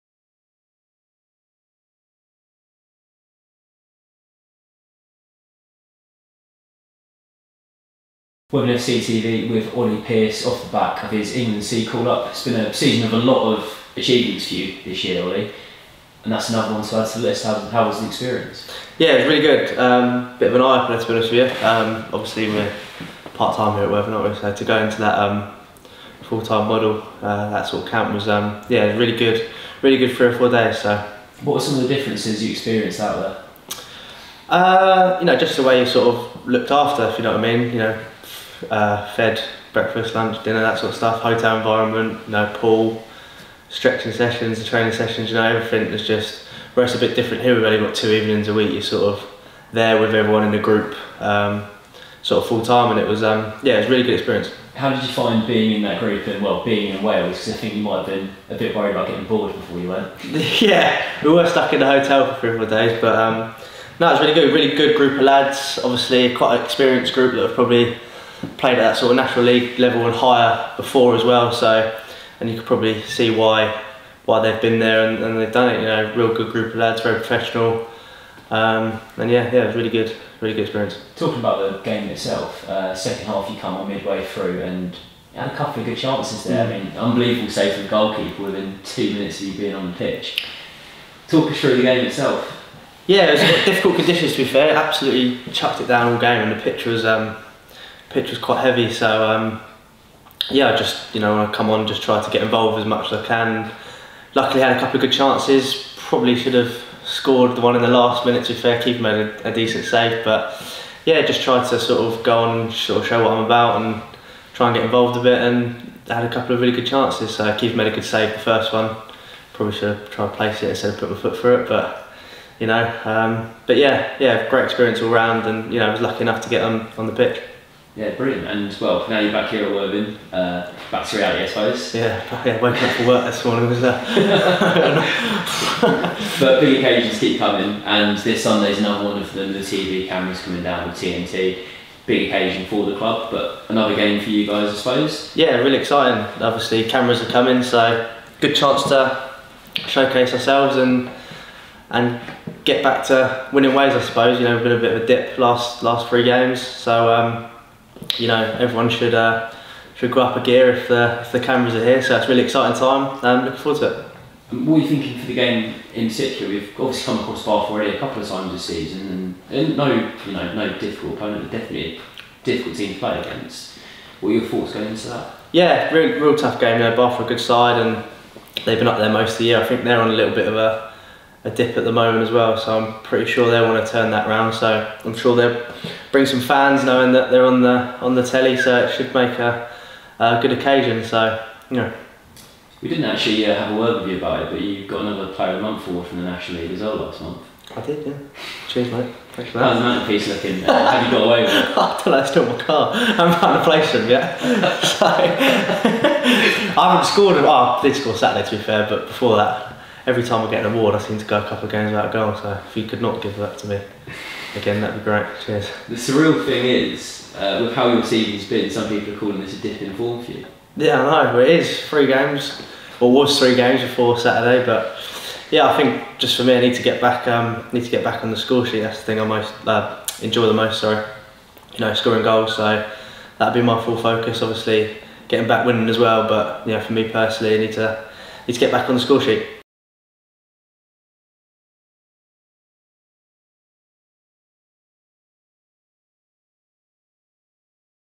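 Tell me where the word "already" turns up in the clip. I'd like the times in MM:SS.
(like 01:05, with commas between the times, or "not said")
02:47.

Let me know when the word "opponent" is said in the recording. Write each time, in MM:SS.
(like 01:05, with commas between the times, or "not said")
02:51.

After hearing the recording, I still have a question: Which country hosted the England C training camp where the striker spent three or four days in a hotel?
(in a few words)
Wales.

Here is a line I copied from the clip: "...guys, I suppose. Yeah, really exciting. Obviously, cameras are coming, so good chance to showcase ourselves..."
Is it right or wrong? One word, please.
right.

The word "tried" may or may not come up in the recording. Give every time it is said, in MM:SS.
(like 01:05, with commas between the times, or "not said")
01:51, 02:00.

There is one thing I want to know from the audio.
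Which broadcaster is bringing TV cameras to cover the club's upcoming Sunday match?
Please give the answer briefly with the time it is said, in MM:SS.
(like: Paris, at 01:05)
TNT, at 02:20.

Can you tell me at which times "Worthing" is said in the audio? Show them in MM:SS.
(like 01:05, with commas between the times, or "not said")
00:08, 00:23, 02:09.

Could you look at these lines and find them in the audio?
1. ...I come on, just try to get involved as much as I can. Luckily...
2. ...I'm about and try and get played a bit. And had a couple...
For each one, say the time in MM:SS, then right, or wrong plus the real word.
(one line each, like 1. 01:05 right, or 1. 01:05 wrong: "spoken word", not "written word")
1. 01:41 right
2. 01:53 wrong: "involved", not "played".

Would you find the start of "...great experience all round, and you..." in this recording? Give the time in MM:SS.
02:04.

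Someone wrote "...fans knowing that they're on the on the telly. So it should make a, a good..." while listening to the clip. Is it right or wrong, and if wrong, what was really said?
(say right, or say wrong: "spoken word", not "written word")
right.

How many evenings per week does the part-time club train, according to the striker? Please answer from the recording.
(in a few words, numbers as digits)
2.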